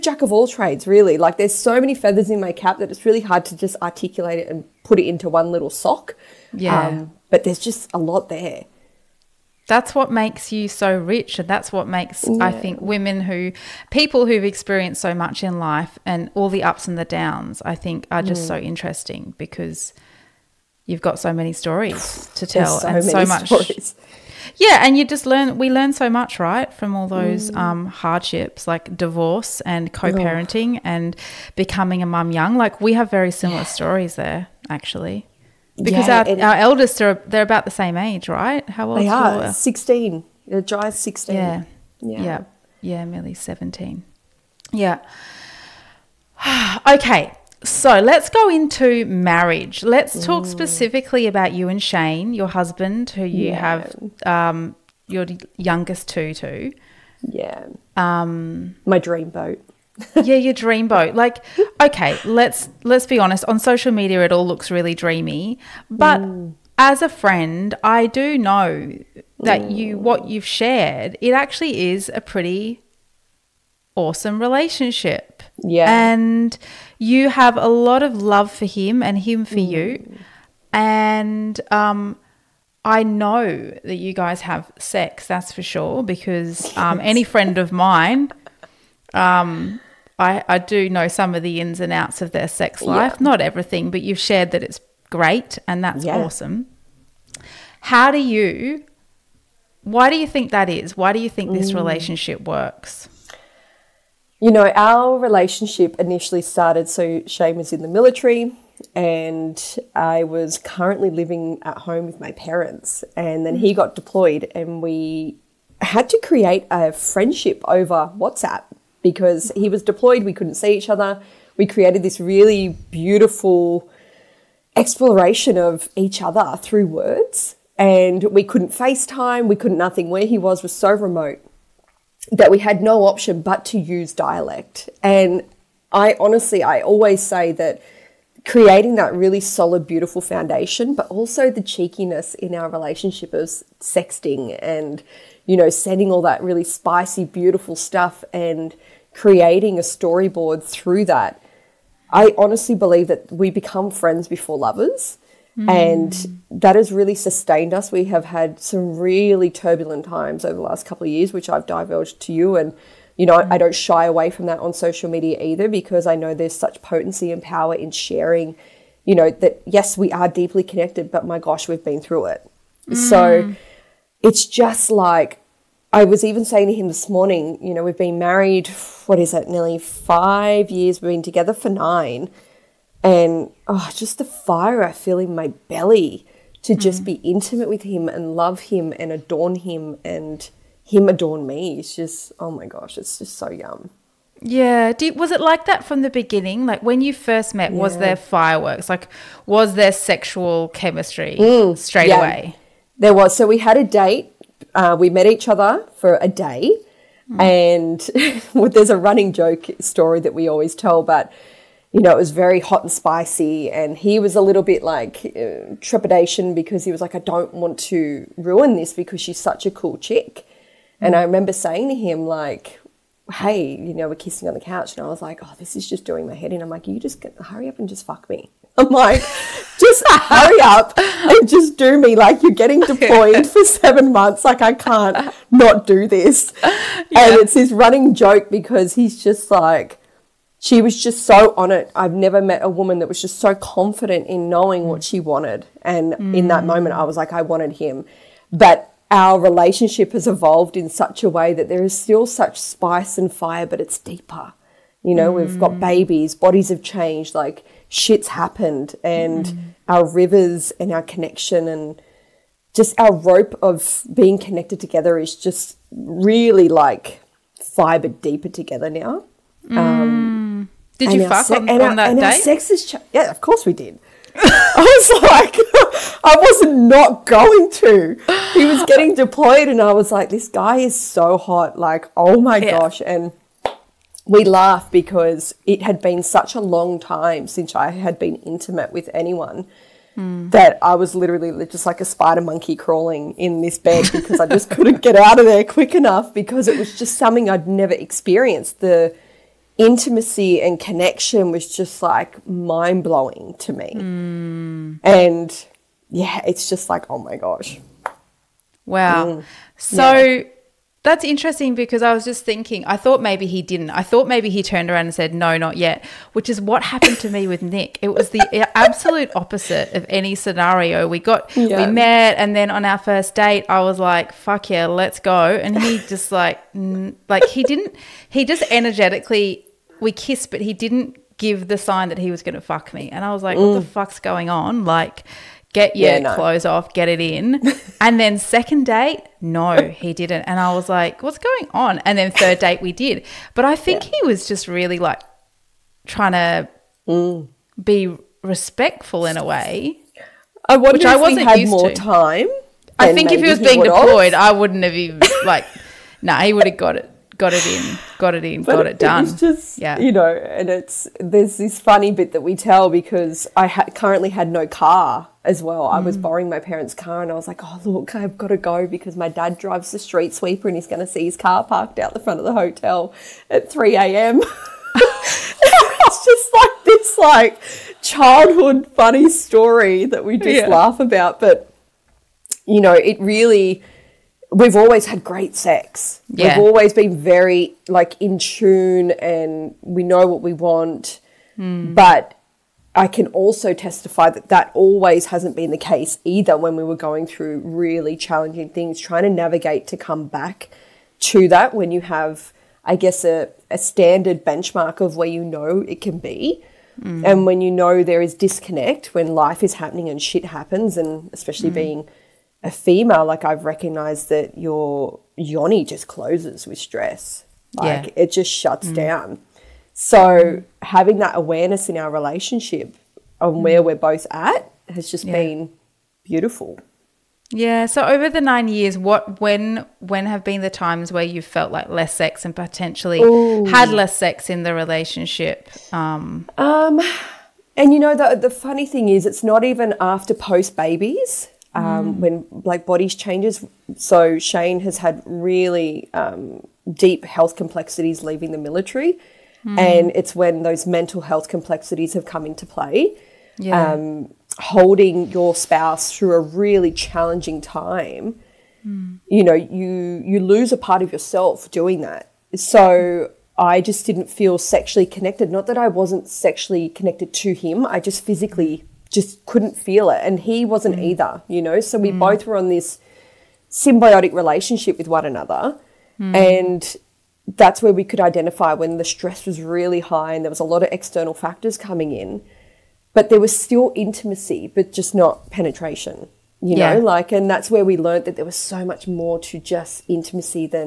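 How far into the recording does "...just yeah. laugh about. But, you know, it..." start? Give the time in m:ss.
6:20.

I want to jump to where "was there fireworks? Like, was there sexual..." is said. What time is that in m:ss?
3:17.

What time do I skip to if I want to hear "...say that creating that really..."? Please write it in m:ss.
2:17.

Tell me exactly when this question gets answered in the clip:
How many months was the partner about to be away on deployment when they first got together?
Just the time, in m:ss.
3:53.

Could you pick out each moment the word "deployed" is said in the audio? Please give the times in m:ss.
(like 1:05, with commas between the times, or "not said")
1:53, 1:59, 3:52, 4:39, 5:53.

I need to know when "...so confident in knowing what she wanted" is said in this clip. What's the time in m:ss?
4:03.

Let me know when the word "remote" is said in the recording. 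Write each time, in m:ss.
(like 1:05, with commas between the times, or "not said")
2:10.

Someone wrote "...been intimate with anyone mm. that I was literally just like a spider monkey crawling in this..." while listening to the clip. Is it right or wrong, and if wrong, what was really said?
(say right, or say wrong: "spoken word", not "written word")
right.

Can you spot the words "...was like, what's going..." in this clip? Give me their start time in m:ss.
5:40.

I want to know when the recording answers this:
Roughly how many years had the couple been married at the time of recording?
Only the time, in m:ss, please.
2:59.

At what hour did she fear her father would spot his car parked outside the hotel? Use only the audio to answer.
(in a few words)
3 a.m.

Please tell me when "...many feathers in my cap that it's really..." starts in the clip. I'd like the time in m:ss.
0:01.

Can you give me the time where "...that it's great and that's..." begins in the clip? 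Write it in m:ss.
1:34.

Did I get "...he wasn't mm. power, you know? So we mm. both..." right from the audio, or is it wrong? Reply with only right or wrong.
wrong.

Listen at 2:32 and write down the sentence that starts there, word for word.
I honestly believe that we become friends before lovers.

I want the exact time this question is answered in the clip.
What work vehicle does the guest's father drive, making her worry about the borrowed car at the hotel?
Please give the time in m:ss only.
6:09.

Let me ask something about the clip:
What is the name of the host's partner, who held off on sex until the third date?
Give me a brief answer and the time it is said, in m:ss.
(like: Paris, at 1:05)
Nick, at 5:17.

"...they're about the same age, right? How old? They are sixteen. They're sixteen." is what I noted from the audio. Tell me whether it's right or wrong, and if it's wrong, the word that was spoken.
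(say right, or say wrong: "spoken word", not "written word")
right.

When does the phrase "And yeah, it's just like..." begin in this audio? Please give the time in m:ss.
5:05.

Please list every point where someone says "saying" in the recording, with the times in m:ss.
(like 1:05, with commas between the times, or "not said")
2:56, 3:41.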